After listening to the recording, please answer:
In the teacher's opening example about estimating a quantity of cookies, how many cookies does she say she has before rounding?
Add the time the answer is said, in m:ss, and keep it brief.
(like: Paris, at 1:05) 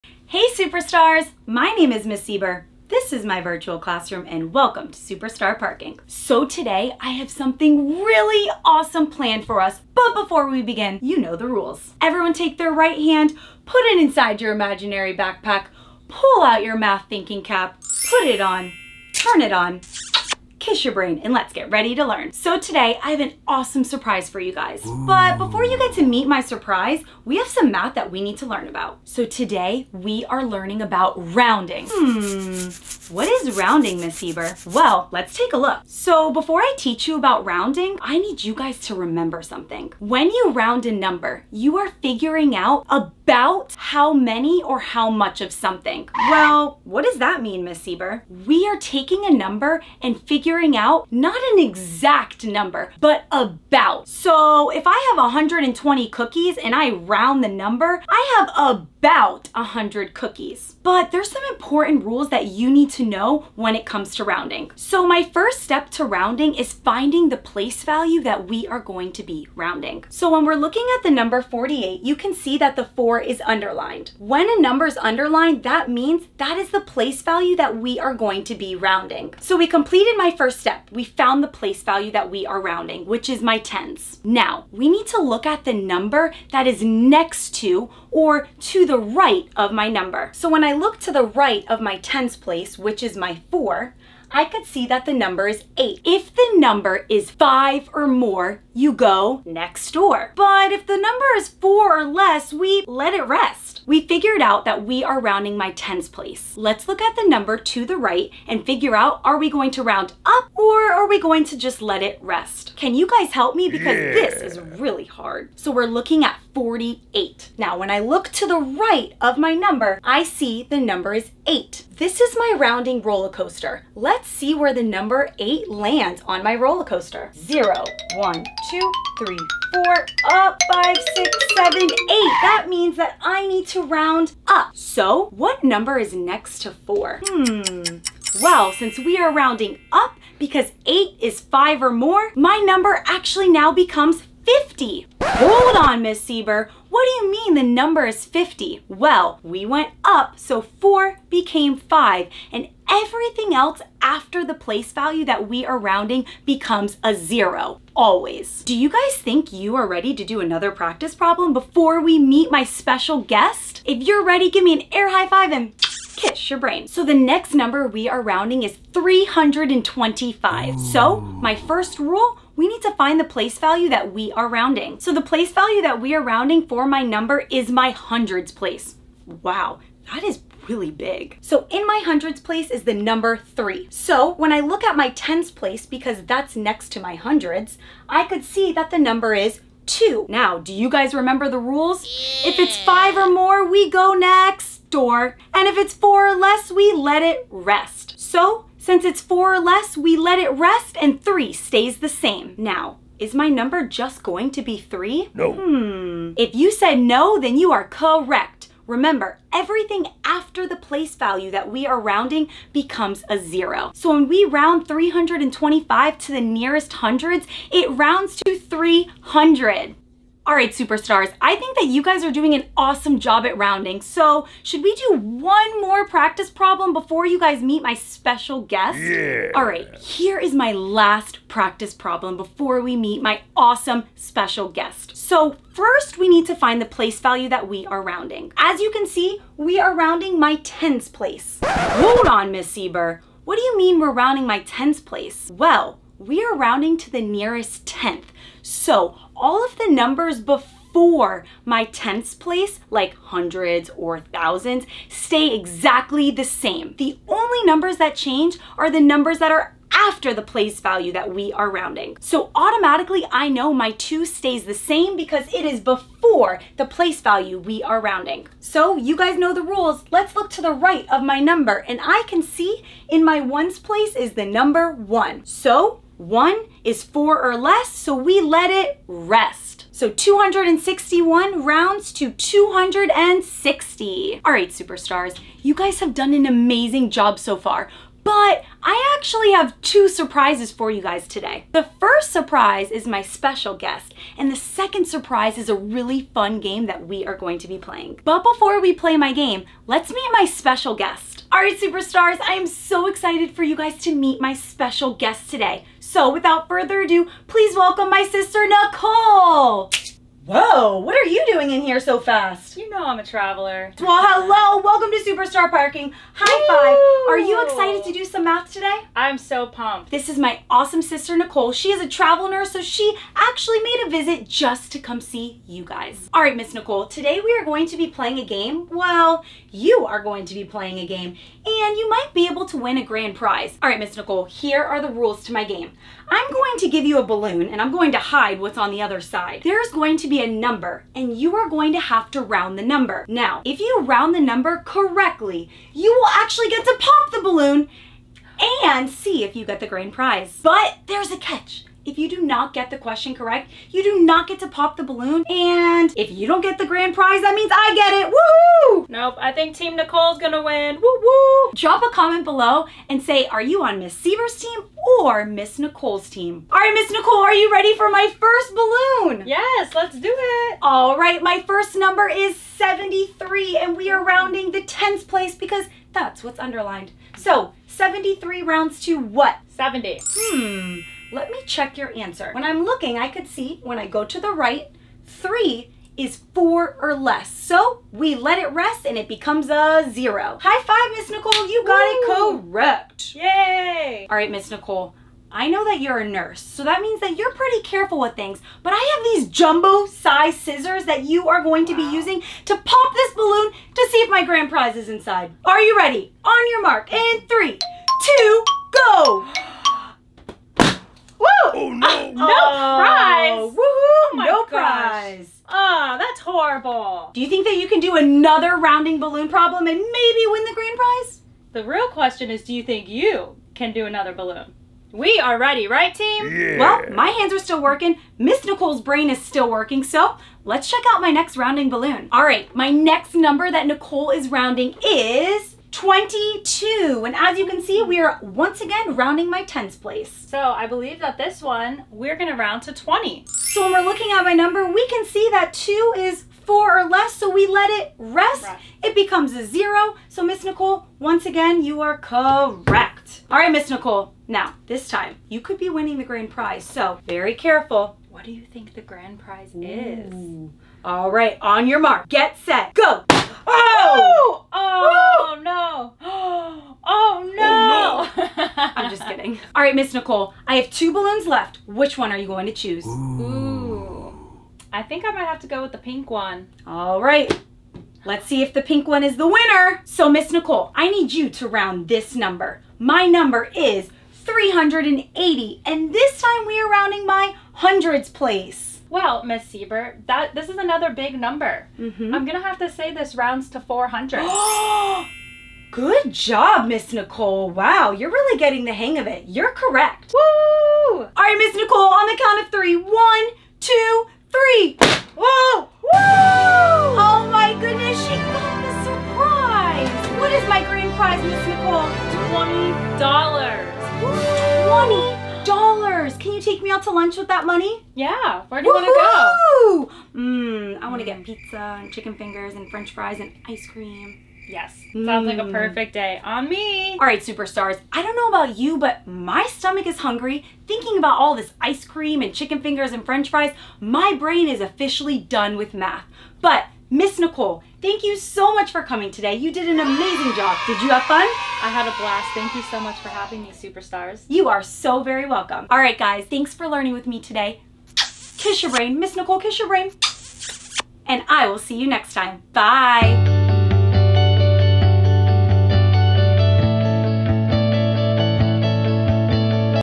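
120, at 0:55.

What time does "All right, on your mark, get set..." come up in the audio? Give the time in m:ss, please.
7:41.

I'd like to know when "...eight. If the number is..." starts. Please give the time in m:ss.
1:35.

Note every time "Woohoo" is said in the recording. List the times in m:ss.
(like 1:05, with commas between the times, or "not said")
5:58, 6:53.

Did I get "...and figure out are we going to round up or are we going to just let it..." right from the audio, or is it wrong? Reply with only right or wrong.
right.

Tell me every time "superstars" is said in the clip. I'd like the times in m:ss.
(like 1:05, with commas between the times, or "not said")
0:00, 0:04, 3:40, 4:44, 5:01, 8:47, 9:03.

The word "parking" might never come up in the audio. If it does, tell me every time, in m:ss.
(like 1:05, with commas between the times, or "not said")
0:05, 5:15.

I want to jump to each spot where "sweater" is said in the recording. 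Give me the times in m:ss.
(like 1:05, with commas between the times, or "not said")
not said.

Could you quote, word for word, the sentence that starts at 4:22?
So automatically I know my two stays the same because it is before the place value we are rounding.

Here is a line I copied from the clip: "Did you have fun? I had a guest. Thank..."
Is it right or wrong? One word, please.
wrong.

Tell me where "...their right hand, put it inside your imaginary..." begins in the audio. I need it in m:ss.
0:12.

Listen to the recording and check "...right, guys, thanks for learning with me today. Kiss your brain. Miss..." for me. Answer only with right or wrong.
right.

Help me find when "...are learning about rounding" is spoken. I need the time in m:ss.
0:30.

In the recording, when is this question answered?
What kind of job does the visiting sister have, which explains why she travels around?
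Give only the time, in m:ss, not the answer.
5:22.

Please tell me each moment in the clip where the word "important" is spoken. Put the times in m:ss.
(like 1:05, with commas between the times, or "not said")
1:01.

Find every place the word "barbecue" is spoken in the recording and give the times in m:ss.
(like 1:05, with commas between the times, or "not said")
not said.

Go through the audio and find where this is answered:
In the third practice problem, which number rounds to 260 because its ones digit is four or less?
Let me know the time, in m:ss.
4:40.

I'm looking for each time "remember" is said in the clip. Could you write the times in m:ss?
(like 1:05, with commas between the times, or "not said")
0:38, 3:11, 3:28.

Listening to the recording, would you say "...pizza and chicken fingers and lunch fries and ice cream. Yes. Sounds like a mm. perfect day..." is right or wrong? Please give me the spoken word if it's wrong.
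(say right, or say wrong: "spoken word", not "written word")
wrong: "french", not "lunch".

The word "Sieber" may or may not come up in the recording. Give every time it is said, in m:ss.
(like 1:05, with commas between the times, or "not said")
0:02, 0:34, 0:47, 2:26, 4:02, 6:04, 8:09.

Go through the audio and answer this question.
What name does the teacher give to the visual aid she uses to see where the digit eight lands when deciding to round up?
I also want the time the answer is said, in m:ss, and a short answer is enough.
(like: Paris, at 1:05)
rounding roller coaster, at 2:02.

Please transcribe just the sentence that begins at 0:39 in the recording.
When you round a number, you are figuring out about how many or how much of something.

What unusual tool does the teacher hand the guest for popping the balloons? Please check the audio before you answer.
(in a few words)
jumbo size scissors.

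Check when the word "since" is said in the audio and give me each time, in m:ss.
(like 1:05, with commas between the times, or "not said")
2:18, 3:18.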